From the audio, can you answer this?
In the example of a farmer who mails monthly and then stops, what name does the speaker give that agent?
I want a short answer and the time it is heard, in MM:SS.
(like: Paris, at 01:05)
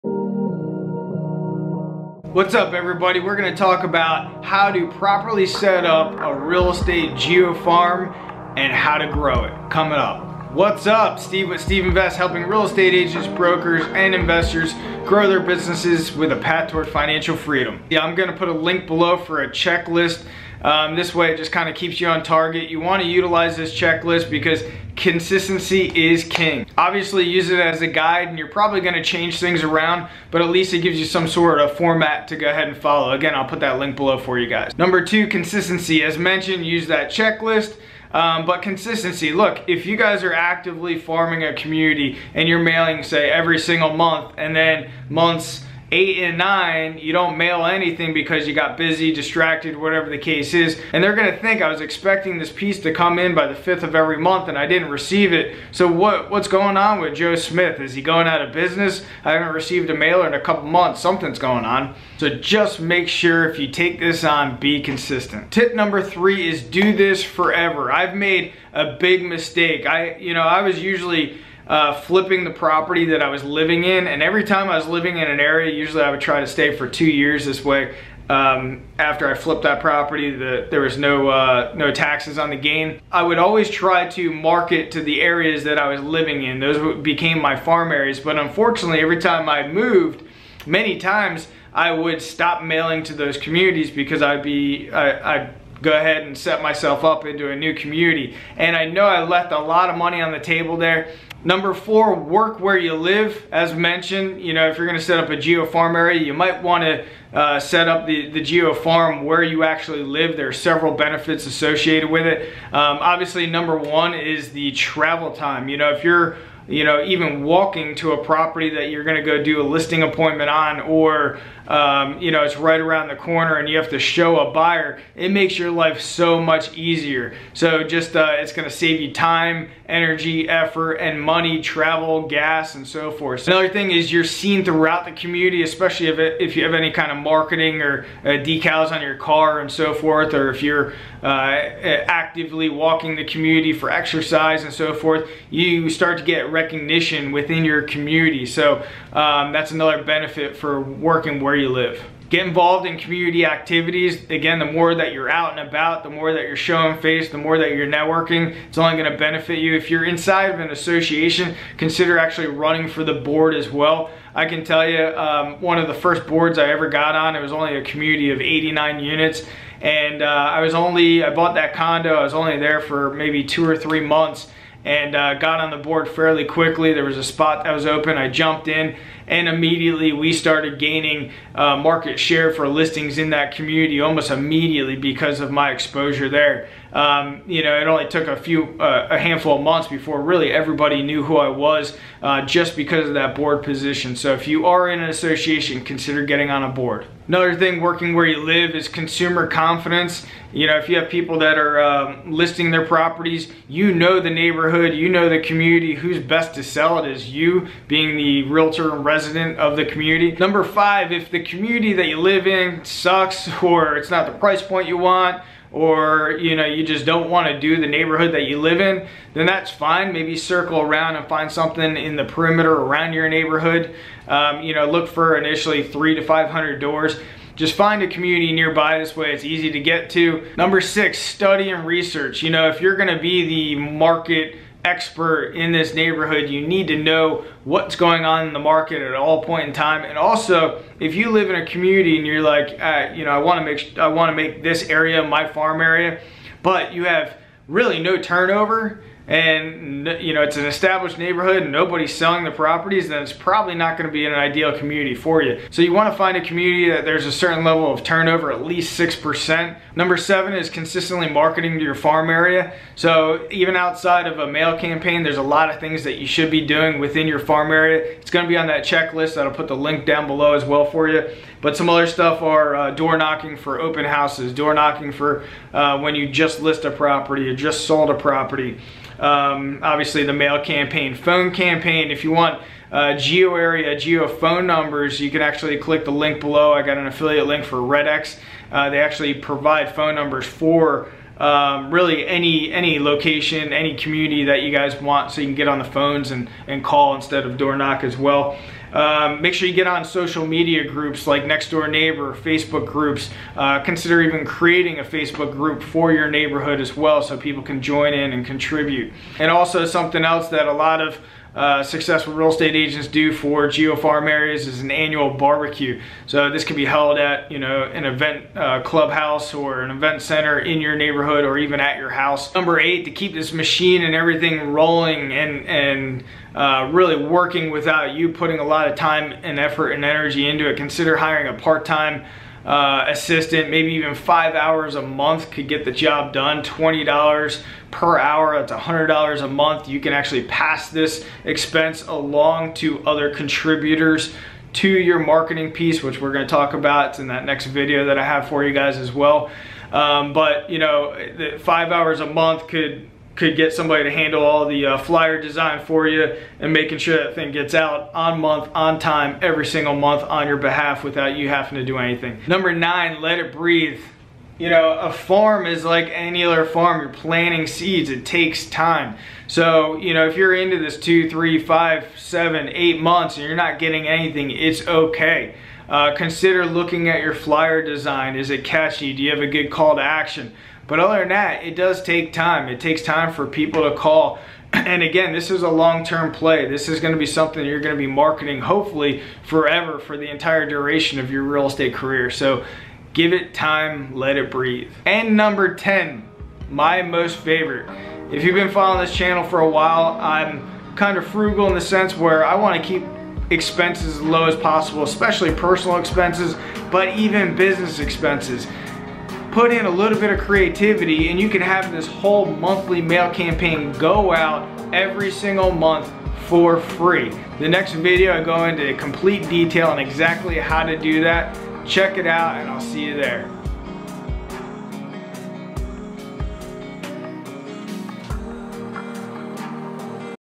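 Joe Smith, at 00:57.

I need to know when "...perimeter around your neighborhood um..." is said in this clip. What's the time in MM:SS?
03:42.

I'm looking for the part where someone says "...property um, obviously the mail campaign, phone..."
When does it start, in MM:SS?
04:38.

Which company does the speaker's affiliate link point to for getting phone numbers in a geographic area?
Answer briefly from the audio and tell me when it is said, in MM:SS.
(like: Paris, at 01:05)
RedX, at 04:47.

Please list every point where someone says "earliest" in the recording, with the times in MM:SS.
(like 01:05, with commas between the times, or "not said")
not said.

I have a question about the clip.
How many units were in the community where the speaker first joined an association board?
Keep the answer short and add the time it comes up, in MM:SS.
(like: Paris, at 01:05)
89, at 02:48.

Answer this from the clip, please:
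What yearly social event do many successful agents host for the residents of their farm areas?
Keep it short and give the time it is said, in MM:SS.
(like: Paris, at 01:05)
annual barbecue, at 05:14.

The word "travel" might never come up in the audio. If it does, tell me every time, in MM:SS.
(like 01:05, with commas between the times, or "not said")
01:54, 02:11.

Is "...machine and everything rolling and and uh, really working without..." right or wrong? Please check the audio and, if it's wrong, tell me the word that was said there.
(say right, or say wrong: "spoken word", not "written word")
right.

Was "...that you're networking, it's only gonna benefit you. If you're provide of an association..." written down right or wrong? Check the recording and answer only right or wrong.
wrong.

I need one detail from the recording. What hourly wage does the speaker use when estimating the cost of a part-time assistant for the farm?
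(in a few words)
$20.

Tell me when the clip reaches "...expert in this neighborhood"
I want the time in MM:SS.
03:54.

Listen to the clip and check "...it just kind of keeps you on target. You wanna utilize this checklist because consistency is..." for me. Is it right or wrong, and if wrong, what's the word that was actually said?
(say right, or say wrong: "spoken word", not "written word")
right.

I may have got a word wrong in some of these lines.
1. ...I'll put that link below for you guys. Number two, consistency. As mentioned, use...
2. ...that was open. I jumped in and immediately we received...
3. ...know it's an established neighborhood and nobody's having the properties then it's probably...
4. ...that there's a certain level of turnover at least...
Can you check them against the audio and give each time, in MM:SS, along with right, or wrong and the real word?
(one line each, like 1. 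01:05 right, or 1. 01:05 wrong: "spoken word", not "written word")
1. 00:33 right
2. 02:57 wrong: "started", not "received"
3. 04:10 wrong: "selling", not "having"
4. 04:16 right.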